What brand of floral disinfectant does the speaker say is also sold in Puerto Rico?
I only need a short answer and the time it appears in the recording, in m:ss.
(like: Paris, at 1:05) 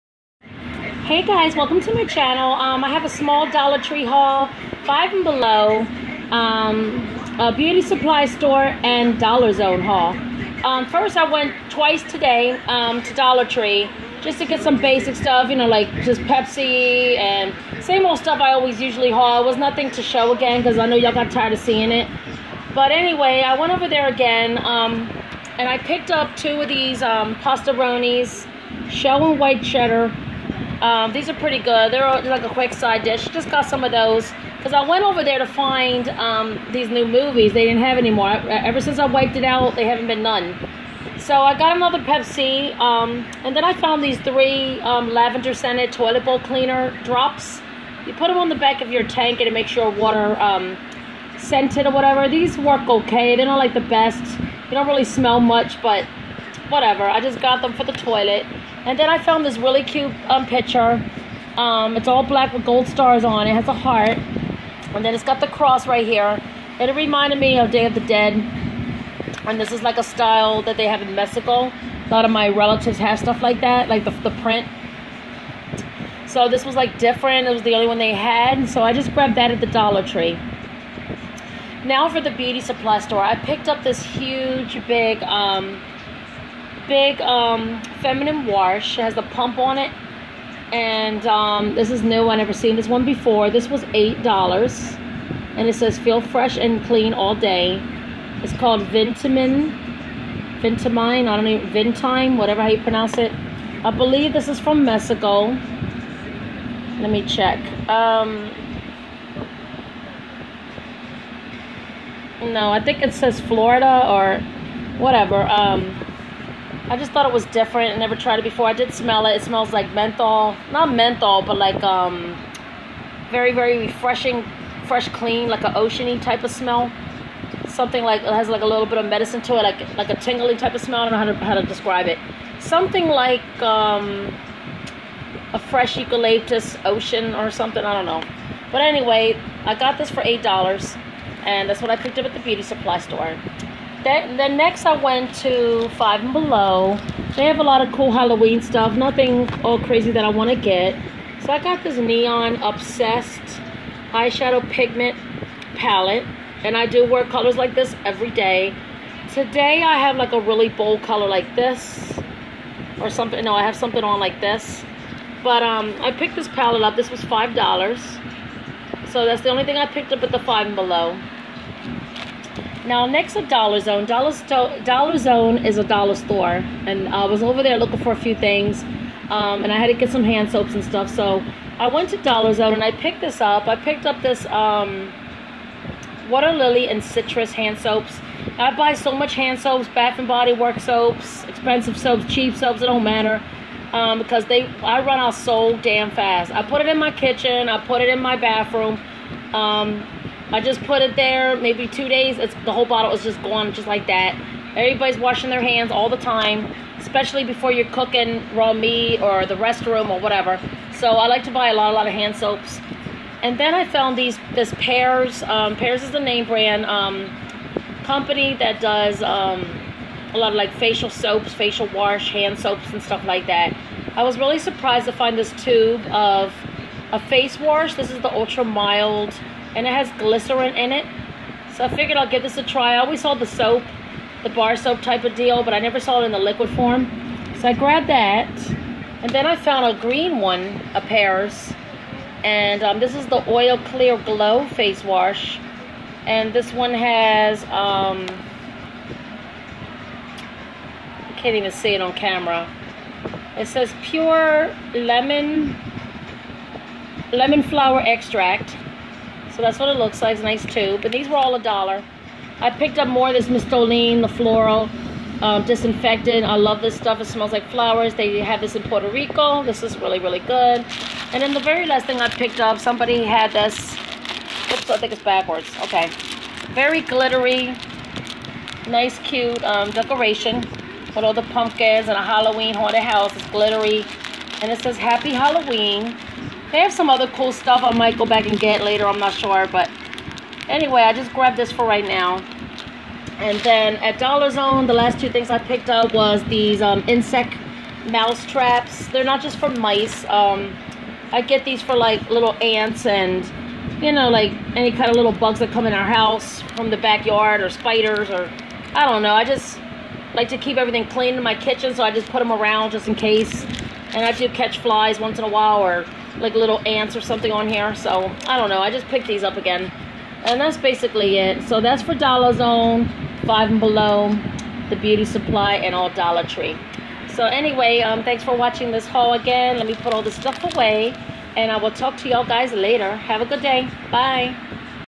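Mistolin, at 4:23.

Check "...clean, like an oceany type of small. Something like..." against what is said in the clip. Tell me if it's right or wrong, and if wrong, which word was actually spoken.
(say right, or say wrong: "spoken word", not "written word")
wrong: "smell", not "small".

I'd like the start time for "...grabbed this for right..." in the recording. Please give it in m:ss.
4:51.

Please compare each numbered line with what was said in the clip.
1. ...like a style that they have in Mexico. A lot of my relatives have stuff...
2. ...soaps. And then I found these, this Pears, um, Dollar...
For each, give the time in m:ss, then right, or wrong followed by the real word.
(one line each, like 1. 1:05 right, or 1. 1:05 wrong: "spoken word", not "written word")
1. 1:09 right
2. 3:32 wrong: "Pears", not "Dollar".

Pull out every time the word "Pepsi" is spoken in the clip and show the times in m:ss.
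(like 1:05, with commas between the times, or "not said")
0:16, 0:41.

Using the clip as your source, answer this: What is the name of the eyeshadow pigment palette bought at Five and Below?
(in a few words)
Neon Obsessed.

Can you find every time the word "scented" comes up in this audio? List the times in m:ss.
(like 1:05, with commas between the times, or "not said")
0:45, 0:51.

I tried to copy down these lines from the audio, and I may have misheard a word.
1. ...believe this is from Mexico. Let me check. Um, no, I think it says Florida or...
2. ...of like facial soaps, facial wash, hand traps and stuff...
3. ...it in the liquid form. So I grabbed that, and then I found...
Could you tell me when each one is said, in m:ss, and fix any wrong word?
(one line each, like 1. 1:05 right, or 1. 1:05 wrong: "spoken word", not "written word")
1. 1:43 right
2. 3:40 wrong: "soaps", not "traps"
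3. 3:56 right.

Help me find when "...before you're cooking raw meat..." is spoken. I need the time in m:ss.
3:27.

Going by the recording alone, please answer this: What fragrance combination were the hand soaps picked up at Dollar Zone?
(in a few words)
Water Lily and Citrus.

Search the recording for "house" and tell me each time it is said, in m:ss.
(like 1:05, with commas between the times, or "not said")
4:43, 5:06.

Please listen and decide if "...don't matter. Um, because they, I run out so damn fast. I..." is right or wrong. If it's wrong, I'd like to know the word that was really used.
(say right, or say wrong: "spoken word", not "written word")
right.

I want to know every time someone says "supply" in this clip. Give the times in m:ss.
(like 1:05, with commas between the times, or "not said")
0:07, 1:22, 2:22, 5:25.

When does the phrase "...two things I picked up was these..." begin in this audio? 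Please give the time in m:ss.
4:55.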